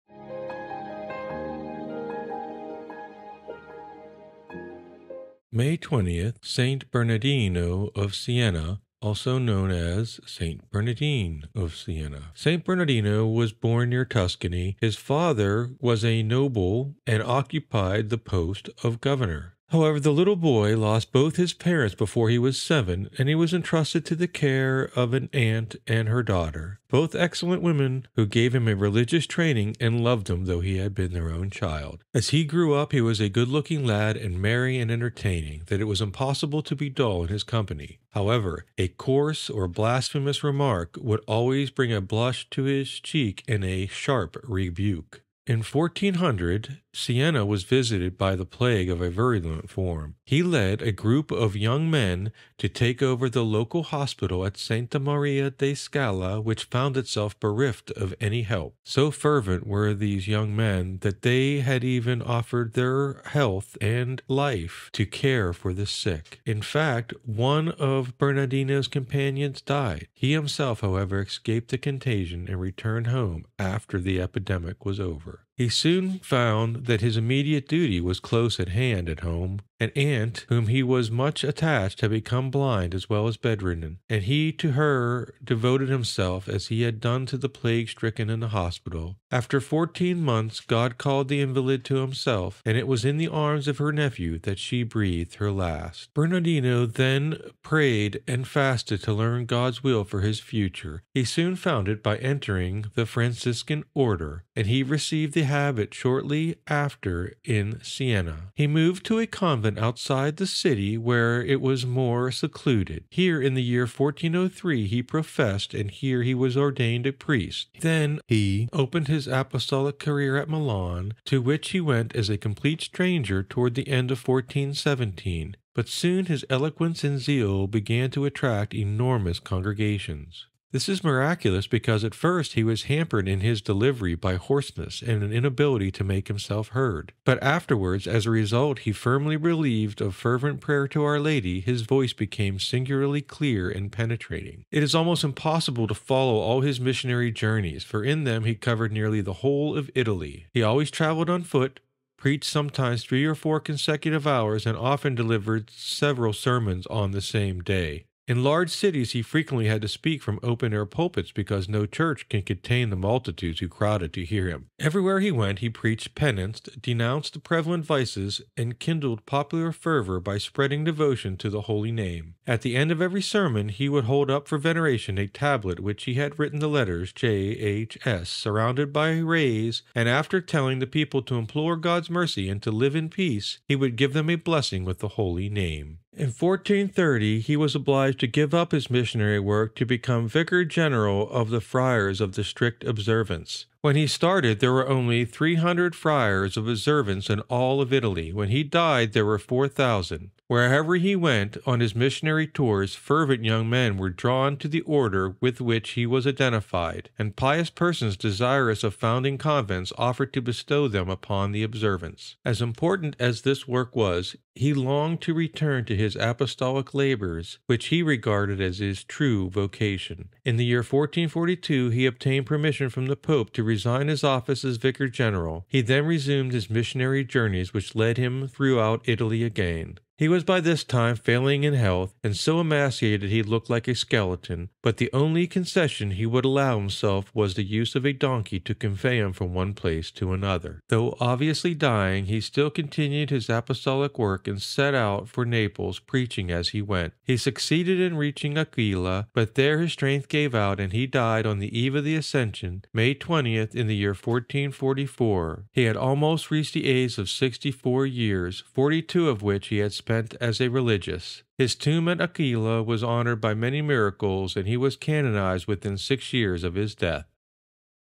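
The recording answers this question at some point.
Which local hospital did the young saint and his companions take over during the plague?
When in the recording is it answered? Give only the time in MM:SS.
00:54.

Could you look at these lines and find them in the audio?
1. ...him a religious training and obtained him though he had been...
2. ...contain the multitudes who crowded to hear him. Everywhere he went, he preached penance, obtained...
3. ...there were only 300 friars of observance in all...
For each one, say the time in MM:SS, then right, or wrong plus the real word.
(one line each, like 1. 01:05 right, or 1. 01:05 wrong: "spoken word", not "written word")
1. 00:28 wrong: "loved", not "obtained"
2. 02:42 wrong: "denounced", not "obtained"
3. 03:14 right.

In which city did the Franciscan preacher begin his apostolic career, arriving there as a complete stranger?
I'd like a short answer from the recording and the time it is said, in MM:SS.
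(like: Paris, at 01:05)
Milan, at 02:00.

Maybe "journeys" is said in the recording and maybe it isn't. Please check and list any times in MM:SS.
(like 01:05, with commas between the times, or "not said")
02:27, 03:47.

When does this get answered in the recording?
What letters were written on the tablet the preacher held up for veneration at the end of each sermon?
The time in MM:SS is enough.
02:57.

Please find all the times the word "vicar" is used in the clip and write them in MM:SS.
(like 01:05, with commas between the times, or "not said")
03:10, 03:44.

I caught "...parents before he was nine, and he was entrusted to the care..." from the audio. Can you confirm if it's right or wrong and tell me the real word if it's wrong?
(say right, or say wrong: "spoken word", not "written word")
wrong: "seven", not "nine".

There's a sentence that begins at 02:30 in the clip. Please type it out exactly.
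He always traveled on foot, preached sometimes three or four consecutive hours, and often delivered several sermons on the same day.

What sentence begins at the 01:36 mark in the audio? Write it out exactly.
Bernardino then prayed and fasted to learn God's will for his future.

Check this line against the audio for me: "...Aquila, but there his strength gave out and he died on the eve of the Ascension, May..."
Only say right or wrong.
right.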